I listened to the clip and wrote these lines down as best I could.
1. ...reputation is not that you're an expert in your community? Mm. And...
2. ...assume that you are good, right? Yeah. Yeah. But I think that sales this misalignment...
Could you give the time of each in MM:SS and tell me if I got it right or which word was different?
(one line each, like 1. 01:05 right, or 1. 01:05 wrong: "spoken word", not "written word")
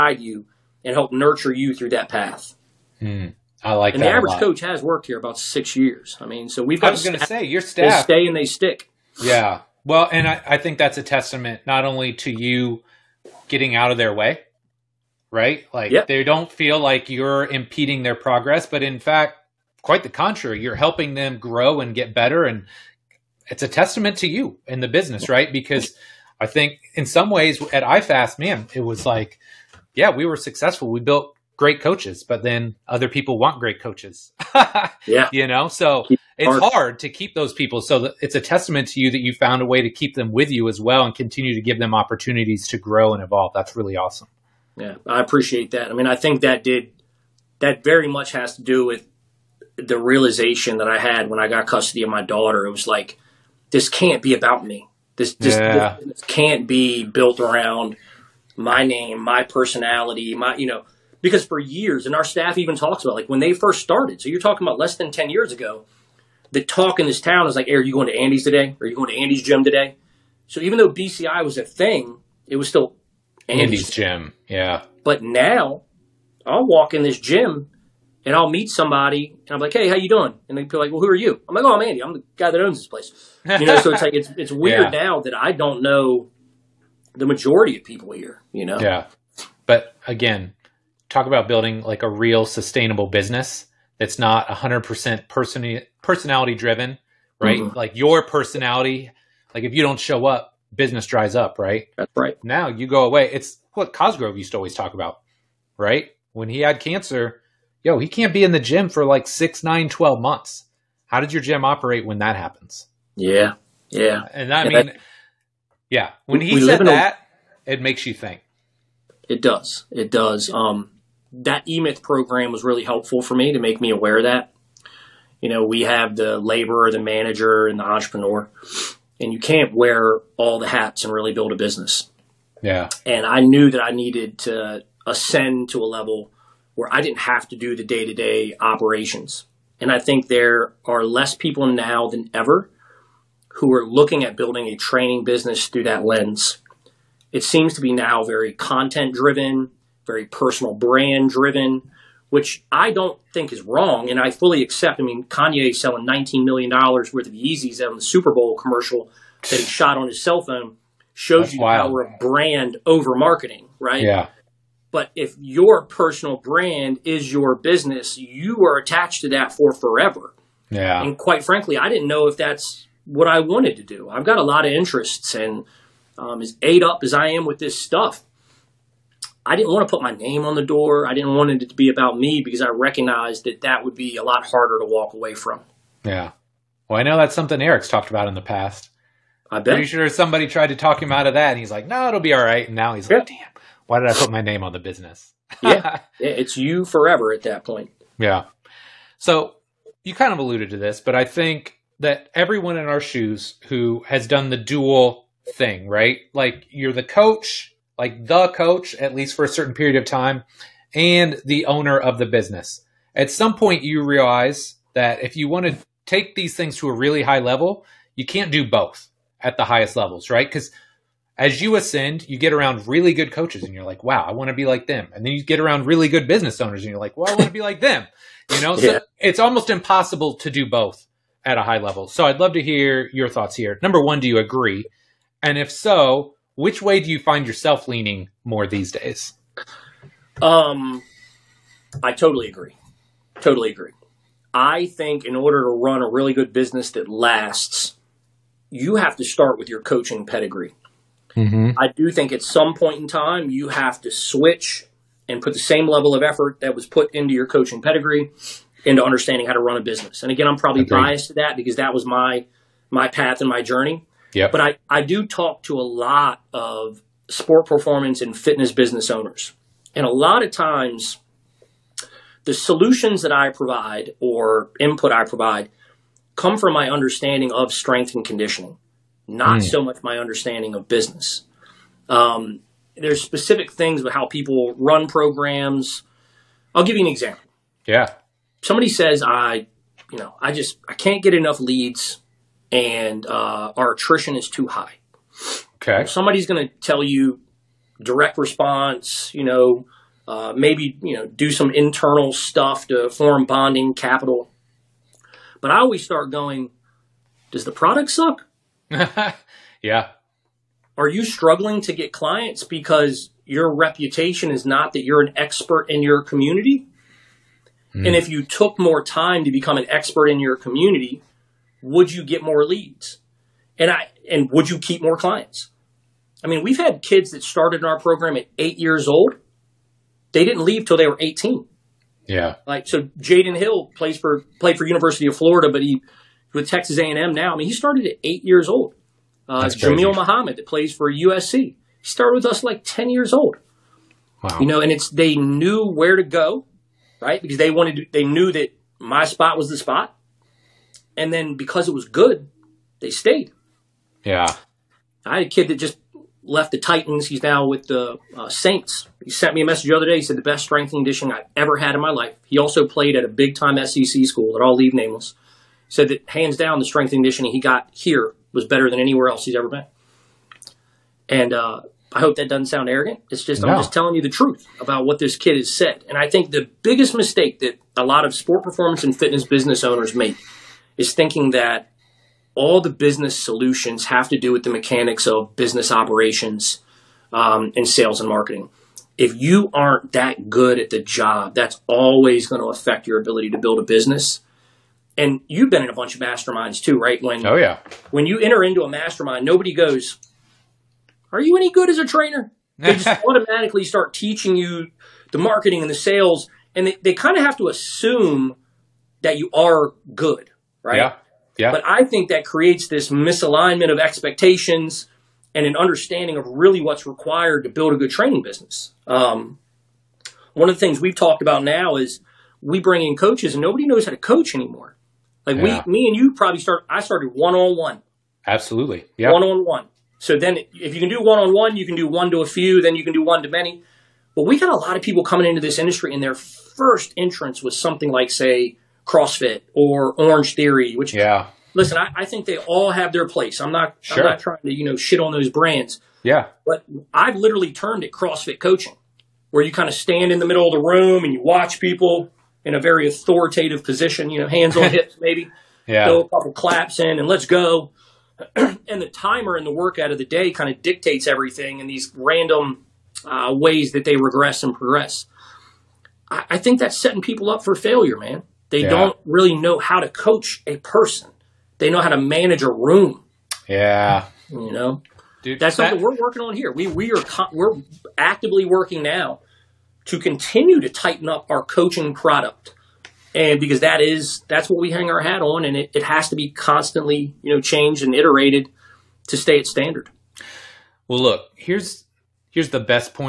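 1. 05:13 right
2. 06:47 wrong: "creates", not "sales".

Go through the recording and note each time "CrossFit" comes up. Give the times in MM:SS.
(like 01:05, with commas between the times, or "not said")
07:19, 07:28.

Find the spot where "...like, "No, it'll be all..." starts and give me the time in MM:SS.
03:11.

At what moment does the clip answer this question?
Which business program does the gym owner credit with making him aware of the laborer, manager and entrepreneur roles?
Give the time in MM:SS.
02:01.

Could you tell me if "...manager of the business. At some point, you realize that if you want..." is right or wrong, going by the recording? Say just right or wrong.
wrong.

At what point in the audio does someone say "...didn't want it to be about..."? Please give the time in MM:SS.
03:01.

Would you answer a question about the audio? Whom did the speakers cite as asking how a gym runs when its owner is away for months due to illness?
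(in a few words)
Cosgrove.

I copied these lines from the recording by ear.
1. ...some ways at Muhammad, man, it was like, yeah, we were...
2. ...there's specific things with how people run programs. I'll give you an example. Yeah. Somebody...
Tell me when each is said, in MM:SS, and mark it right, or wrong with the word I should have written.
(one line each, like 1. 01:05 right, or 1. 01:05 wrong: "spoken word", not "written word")
1. 00:27 wrong: "IFAST", not "Muhammad"
2. 04:42 right.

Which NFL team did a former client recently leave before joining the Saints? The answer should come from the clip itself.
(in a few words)
Titans.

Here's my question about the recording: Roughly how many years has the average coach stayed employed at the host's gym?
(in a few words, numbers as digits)
6 years.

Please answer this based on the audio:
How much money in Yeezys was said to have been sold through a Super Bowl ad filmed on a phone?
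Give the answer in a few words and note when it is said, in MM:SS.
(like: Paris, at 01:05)
$19 million, at 02:36.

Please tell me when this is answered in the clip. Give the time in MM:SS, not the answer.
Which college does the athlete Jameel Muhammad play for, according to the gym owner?
05:41.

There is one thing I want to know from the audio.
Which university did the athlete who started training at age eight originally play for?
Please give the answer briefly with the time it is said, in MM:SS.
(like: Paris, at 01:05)
University of Florida, at 05:34.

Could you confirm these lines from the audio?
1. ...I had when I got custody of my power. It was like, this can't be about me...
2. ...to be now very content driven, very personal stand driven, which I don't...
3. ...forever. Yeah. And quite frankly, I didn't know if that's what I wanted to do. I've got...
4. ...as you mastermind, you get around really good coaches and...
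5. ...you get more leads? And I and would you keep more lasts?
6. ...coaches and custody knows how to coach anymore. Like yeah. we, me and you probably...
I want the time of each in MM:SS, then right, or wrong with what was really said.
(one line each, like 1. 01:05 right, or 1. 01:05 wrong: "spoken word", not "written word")
1. 00:50 wrong: "daughter", not "power"
2. 02:27 wrong: "brand", not "stand"
3. 02:49 right
4. 03:41 wrong: "ascend", not "mastermind"
5. 05:22 wrong: "clients", not "lasts"
6. 07:03 wrong: "nobody", not "custody".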